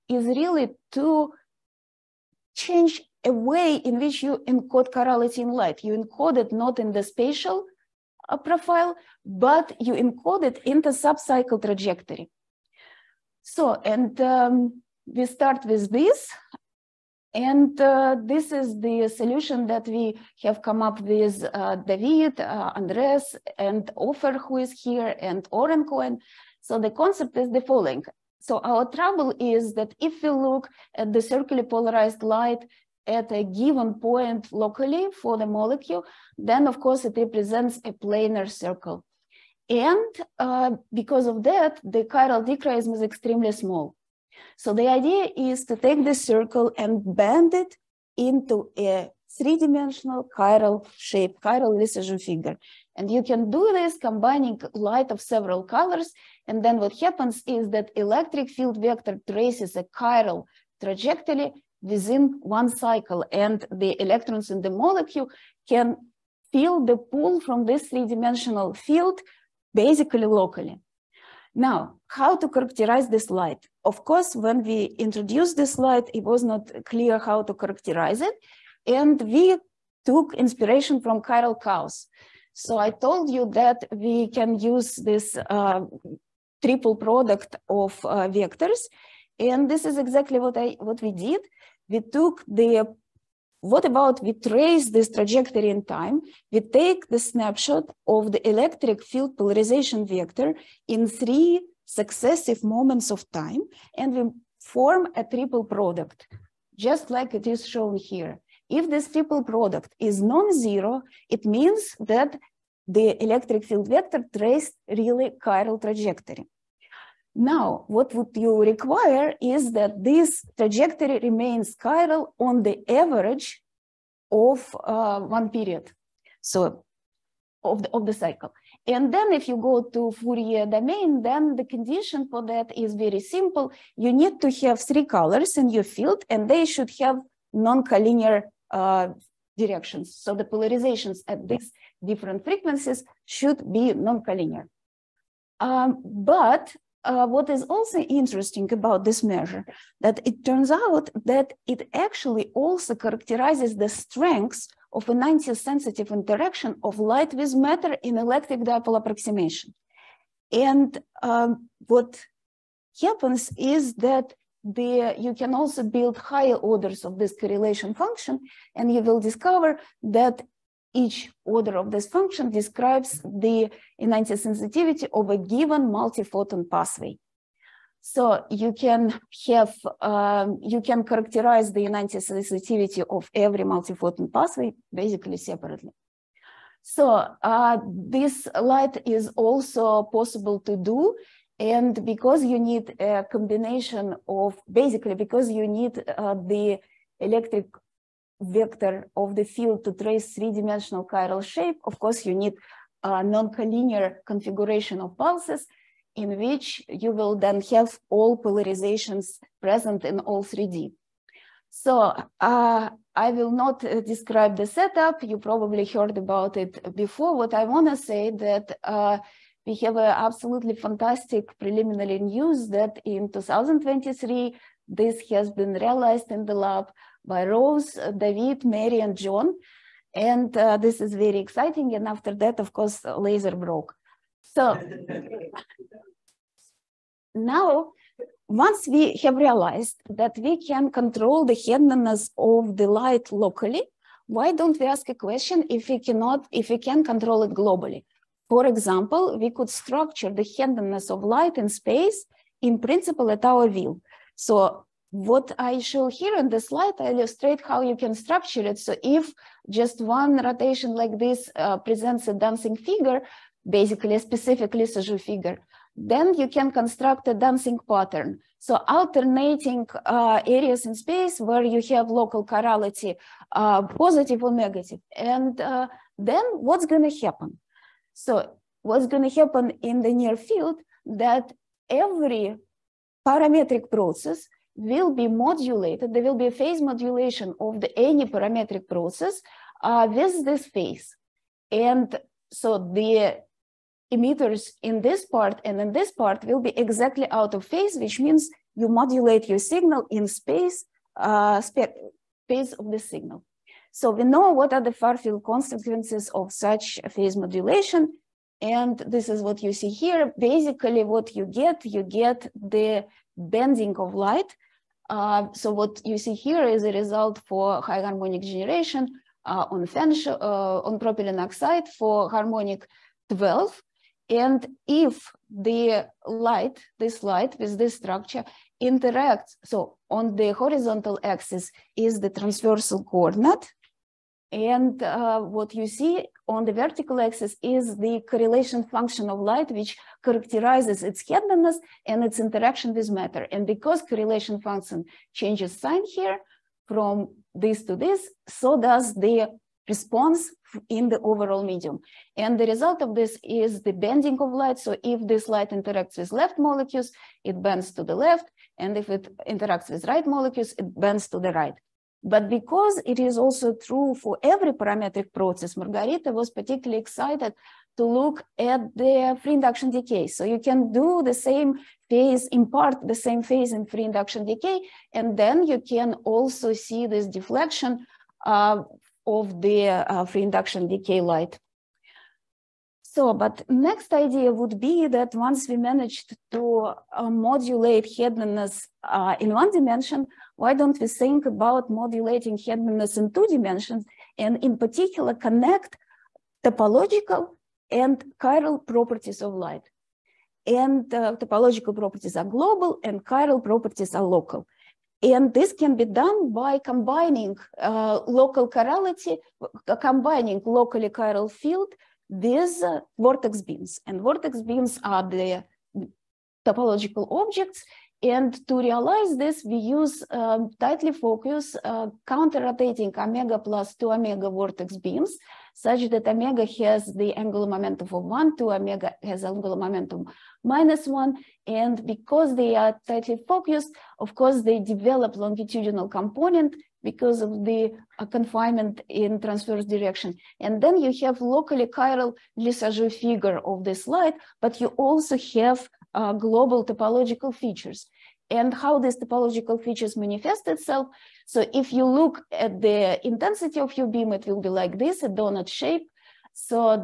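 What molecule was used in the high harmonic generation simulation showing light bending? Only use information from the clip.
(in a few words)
propylene oxide.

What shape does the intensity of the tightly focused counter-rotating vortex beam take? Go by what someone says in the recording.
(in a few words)
donut shape.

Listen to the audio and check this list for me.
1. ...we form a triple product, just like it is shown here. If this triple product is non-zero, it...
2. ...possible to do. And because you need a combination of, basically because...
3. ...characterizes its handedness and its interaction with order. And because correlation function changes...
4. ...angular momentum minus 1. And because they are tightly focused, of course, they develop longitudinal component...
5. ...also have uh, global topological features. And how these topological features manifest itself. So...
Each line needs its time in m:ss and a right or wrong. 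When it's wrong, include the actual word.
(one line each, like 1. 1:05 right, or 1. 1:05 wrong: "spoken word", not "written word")
1. 1:44 right
2. 3:10 right
3. 5:40 wrong: "matter", not "order"
4. 7:09 right
5. 7:24 right.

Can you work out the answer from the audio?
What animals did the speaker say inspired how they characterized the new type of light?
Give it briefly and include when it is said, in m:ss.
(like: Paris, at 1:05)
chiral cows, at 1:21.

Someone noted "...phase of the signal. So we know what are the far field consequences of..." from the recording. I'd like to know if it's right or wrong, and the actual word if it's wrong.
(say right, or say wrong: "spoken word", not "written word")
right.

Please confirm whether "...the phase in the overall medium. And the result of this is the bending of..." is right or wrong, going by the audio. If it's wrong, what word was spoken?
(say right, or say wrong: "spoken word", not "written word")
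wrong: "response", not "phase".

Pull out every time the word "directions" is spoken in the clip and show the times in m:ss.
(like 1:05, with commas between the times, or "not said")
2:19, 7:19.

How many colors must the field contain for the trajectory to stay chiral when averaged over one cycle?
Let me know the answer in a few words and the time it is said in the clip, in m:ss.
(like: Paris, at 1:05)
3, at 2:14.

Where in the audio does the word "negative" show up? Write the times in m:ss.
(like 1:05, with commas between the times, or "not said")
4:34.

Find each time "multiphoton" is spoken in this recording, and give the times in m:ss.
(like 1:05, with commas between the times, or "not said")
2:55, 3:03.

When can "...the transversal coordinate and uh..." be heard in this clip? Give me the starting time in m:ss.
5:32.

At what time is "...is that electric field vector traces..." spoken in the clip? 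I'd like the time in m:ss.
0:57.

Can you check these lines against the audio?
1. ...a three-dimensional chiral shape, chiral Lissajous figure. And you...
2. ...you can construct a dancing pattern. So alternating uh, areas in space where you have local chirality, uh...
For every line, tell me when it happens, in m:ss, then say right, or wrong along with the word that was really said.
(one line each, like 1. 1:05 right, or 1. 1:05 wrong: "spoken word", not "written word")
1. 0:48 right
2. 4:26 right.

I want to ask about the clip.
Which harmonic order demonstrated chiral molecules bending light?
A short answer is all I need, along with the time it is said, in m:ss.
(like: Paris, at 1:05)
12, at 5:22.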